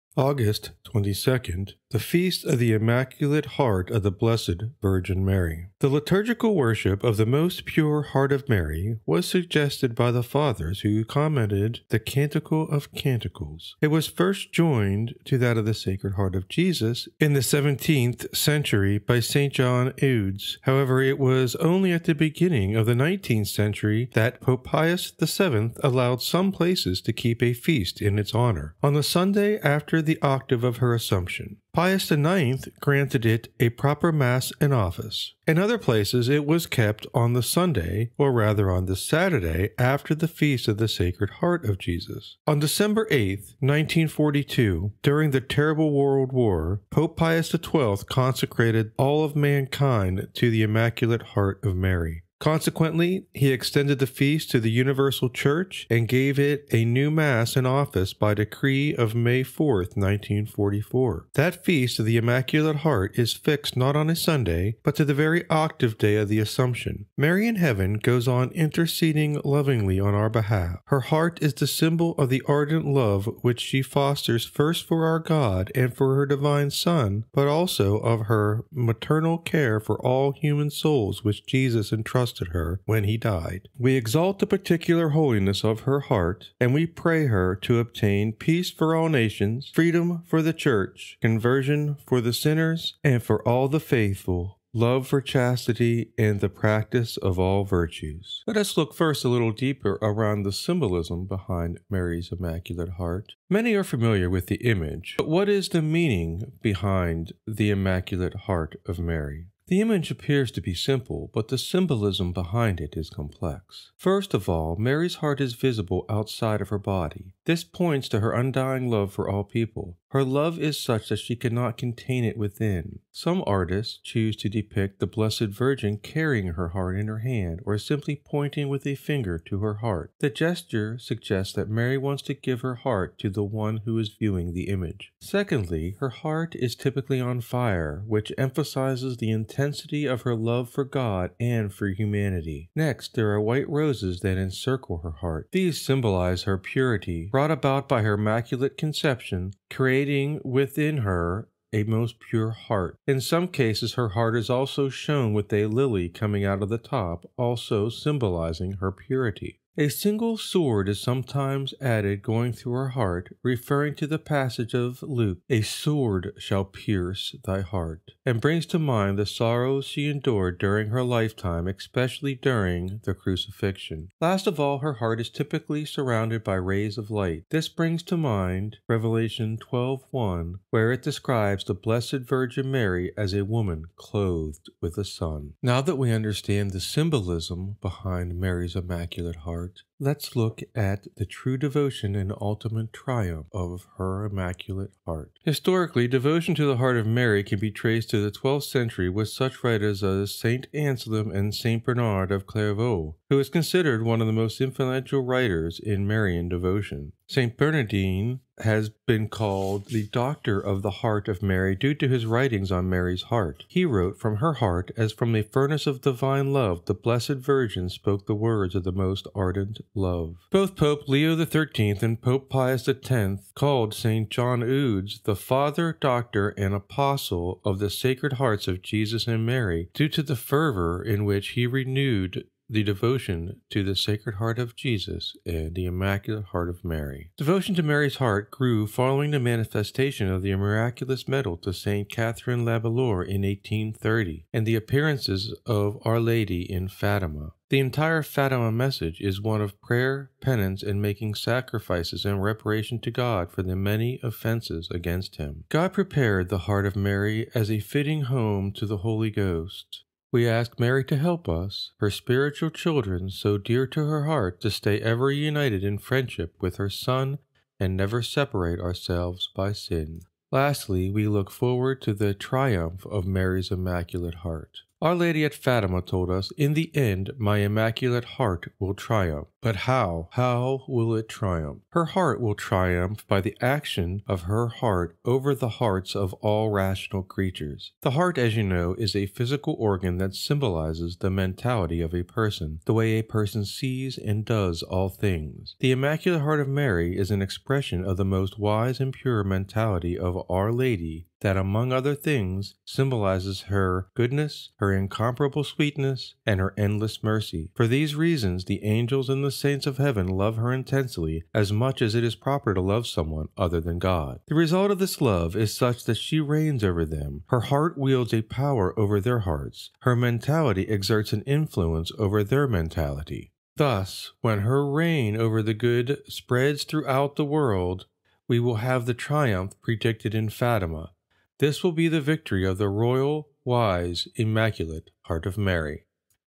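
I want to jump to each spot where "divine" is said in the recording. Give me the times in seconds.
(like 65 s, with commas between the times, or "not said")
76 s, 216 s.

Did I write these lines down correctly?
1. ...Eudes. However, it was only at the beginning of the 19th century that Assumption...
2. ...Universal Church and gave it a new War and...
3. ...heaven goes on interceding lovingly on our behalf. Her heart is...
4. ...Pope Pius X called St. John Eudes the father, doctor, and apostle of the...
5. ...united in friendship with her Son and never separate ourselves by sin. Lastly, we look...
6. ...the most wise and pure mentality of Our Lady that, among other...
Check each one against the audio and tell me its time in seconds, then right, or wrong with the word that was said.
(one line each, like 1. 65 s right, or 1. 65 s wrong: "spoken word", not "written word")
1. 20 s wrong: "Pope", not "Assumption"
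2. 54 s wrong: "Mass", not "War"
3. 67 s right
4. 222 s right
5. 265 s right
6. 298 s right.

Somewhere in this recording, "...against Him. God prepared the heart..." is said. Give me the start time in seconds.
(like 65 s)
254 s.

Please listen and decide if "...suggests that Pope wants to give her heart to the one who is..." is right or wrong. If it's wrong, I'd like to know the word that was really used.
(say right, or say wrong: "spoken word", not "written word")
wrong: "Mary", not "Pope".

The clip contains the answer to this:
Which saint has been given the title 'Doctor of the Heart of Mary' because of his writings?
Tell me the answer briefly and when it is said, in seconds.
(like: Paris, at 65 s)
St. Bernardine, at 207 s.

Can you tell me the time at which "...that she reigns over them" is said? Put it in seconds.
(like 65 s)
316 s.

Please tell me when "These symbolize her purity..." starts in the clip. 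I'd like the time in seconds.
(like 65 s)
145 s.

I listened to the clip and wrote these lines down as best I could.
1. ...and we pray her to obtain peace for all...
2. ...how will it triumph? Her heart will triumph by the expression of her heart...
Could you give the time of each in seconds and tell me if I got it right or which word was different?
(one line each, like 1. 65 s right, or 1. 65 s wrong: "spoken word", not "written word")
1. 86 s right
2. 280 s wrong: "action", not "expression".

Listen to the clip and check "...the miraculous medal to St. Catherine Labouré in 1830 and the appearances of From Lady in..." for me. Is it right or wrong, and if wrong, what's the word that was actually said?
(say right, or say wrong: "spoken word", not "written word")
wrong: "Our", not "From".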